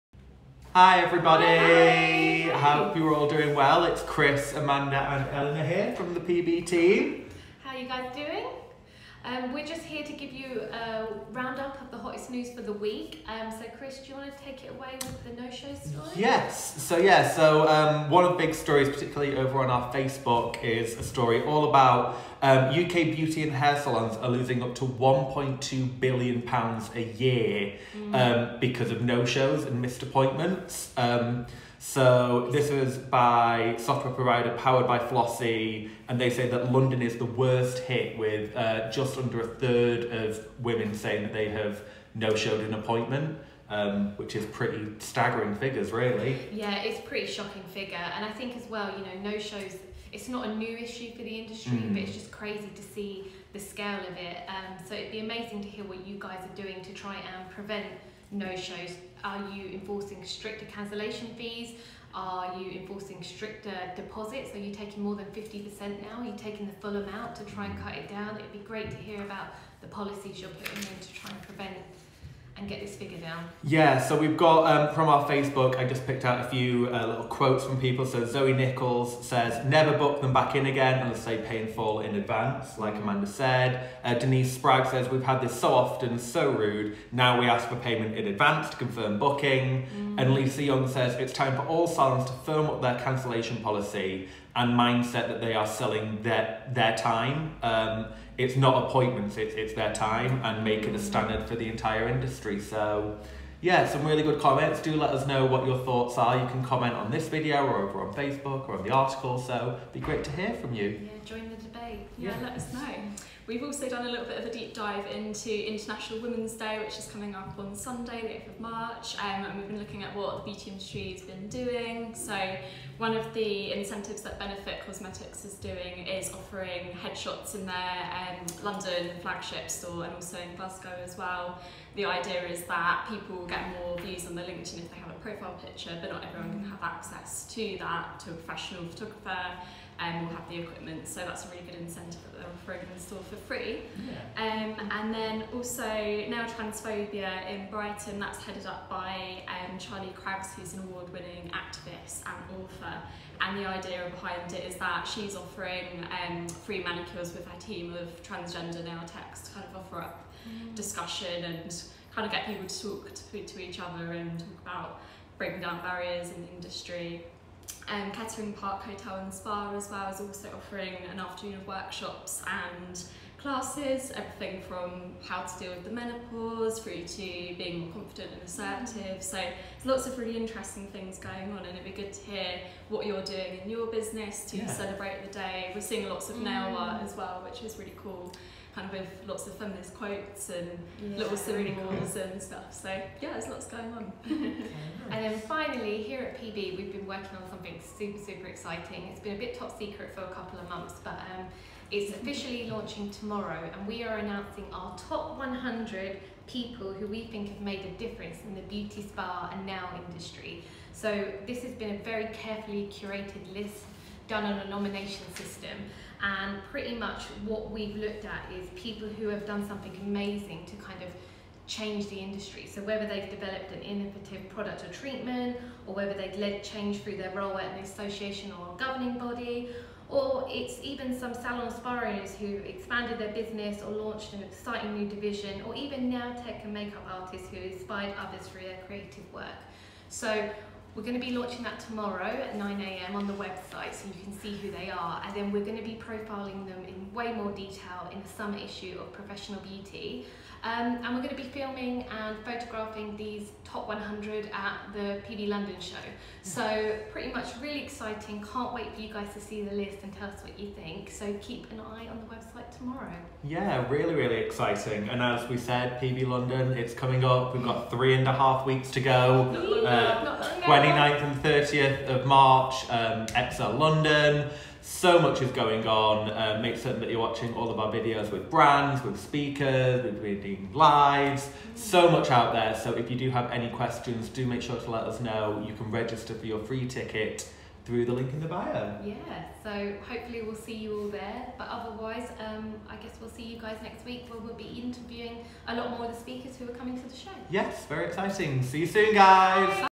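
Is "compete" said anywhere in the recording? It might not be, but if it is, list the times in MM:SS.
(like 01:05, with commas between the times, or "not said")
not said.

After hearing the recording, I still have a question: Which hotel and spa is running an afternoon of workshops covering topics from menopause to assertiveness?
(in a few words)
Kettering Park Hotel and Spa.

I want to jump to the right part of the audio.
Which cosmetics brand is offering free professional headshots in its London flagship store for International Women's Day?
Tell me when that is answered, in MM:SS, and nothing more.
02:04.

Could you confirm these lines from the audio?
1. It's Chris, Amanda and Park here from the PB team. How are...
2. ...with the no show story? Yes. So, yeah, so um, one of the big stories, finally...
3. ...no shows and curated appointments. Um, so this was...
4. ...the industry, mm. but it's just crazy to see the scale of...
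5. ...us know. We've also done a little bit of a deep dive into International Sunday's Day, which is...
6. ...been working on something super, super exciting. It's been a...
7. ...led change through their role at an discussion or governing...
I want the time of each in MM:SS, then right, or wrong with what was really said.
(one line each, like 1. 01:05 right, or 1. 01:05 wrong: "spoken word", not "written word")
1. 00:03 wrong: "Eleanor", not "Park"
2. 00:15 wrong: "particularly", not "finally"
3. 00:29 wrong: "missed", not "curated"
4. 00:51 right
5. 01:52 wrong: "Women", not "Sunday"
6. 03:16 right
7. 03:46 wrong: "association", not "discussion".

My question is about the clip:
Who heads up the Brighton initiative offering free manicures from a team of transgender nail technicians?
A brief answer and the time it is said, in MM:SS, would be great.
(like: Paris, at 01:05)
Charlie Craggs, at 02:29.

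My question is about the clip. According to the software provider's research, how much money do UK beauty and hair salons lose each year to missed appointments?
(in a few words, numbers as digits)
£1.2 billion.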